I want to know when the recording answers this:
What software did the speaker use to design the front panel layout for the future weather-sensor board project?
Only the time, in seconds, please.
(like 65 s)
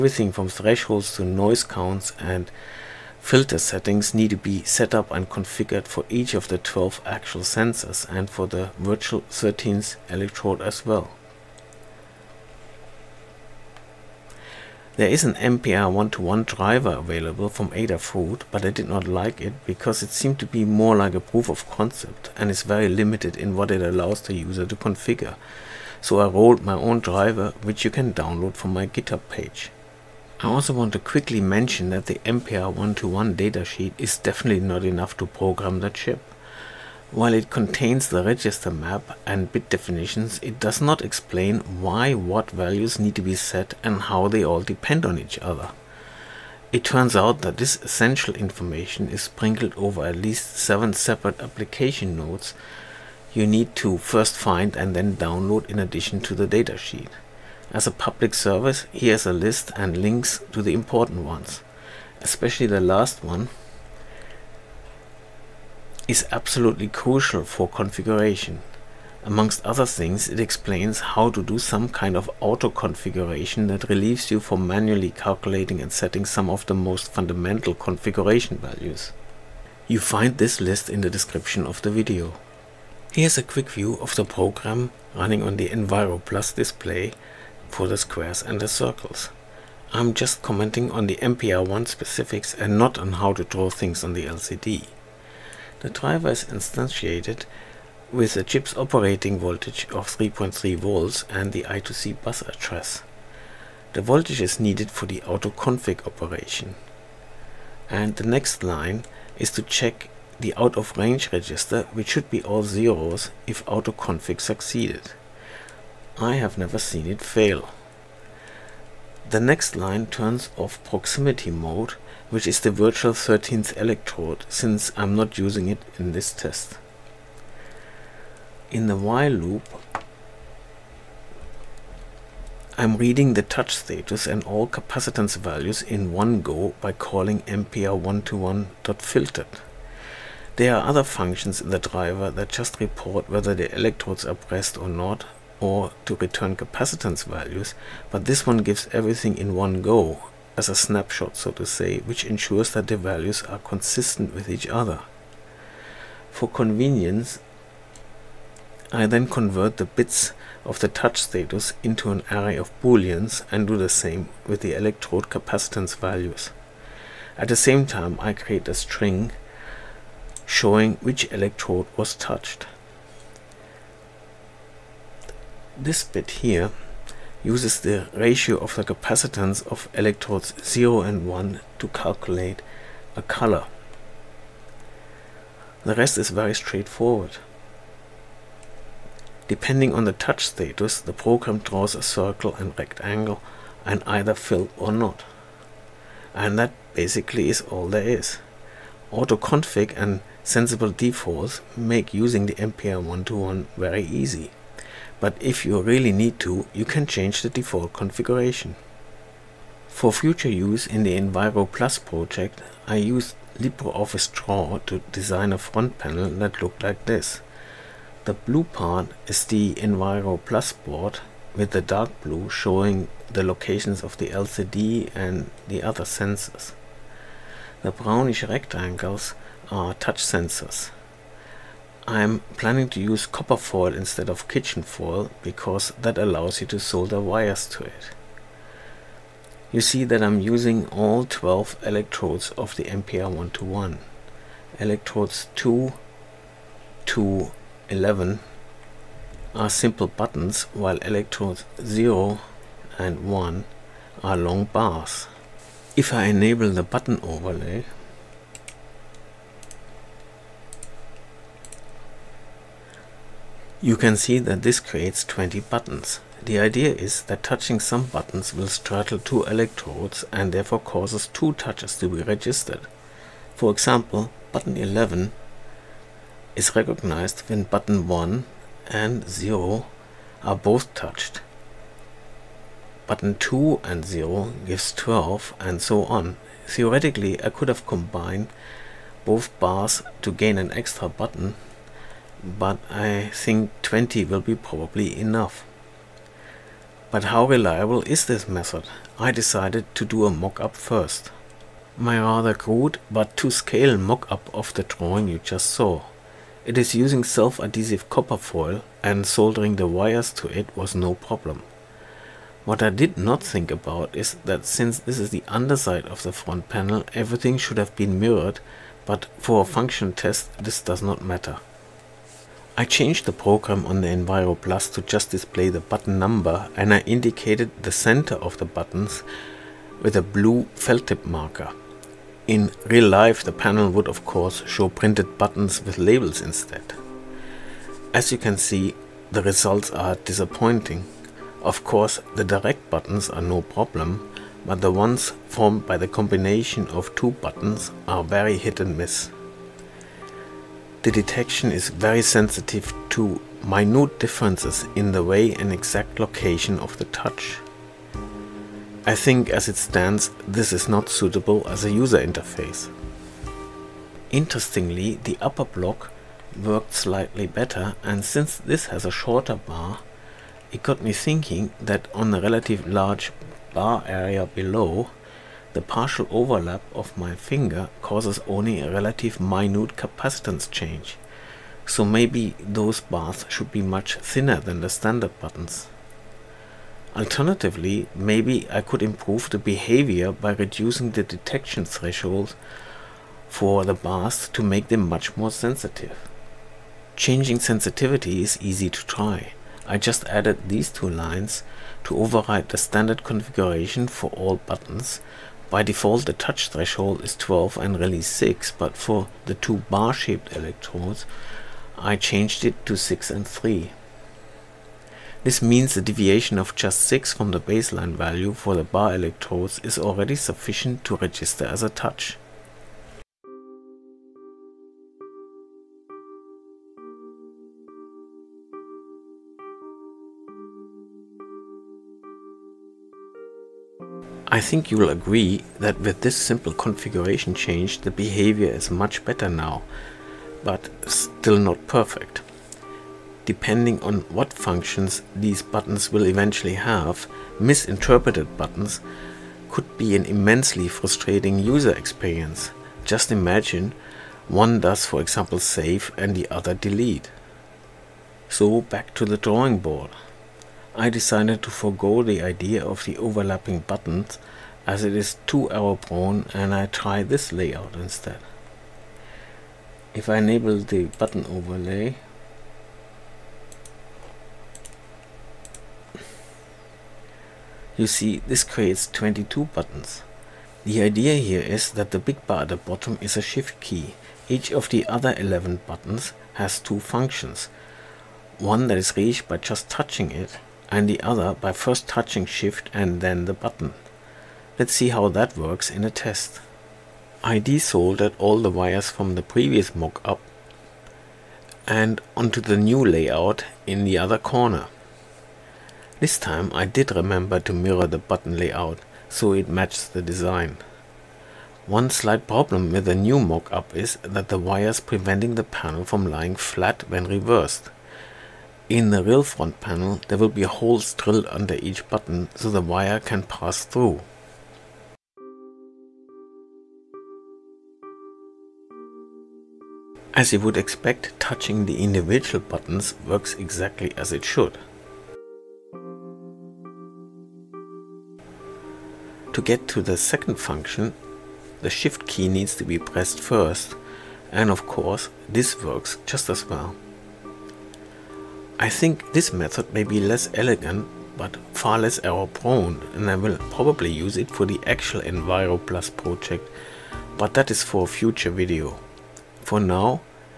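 213 s.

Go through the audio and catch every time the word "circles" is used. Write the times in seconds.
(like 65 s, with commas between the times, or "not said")
88 s, 192 s.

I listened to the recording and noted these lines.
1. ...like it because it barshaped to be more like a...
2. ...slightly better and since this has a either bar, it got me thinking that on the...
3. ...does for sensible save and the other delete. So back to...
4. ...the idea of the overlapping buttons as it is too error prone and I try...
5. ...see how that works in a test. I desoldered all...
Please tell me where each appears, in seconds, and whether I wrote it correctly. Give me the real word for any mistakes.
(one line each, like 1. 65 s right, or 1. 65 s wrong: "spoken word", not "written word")
1. 19 s wrong: "seemed", not "barshaped"
2. 366 s wrong: "shorter", not "either"
3. 454 s wrong: "example", not "sensible"
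4. 462 s right
5. 494 s right.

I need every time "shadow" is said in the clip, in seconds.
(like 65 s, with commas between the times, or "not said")
not said.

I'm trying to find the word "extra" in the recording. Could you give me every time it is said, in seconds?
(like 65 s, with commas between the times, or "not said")
290 s.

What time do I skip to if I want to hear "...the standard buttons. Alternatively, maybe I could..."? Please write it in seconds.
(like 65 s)
384 s.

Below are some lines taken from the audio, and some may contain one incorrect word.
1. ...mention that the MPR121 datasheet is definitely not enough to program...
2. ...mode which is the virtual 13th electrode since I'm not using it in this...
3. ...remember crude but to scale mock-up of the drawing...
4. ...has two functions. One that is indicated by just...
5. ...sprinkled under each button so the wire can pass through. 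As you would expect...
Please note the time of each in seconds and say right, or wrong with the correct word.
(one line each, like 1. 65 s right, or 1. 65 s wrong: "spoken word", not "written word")
1. 31 s right
2. 121 s right
3. 302 s wrong: "rather", not "remember"
4. 486 s wrong: "reached", not "indicated"
5. 521 s wrong: "drilled", not "sprinkled".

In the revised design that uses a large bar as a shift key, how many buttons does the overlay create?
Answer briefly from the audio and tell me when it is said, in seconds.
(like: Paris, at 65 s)
22, at 479 s.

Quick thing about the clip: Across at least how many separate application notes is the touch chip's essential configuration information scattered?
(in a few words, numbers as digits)
7.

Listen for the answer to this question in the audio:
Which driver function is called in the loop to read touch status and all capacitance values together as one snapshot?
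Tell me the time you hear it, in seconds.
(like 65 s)
137 s.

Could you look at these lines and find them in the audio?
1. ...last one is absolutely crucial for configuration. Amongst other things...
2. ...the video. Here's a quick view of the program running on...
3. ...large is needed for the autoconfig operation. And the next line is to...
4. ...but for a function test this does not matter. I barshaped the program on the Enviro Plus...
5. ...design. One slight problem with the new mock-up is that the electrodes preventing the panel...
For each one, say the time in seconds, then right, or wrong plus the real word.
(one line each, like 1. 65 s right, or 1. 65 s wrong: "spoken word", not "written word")
1. 62 s right
2. 81 s right
3. 103 s wrong: "voltage", not "large"
4. 319 s wrong: "changed", not "barshaped"
5. 510 s wrong: "wires", not "electrodes".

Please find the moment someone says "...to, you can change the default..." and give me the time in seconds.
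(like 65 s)
206 s.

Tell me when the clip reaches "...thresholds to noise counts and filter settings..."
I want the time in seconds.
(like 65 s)
0 s.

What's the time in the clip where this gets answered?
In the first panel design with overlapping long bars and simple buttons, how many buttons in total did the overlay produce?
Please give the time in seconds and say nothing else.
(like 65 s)
265 s.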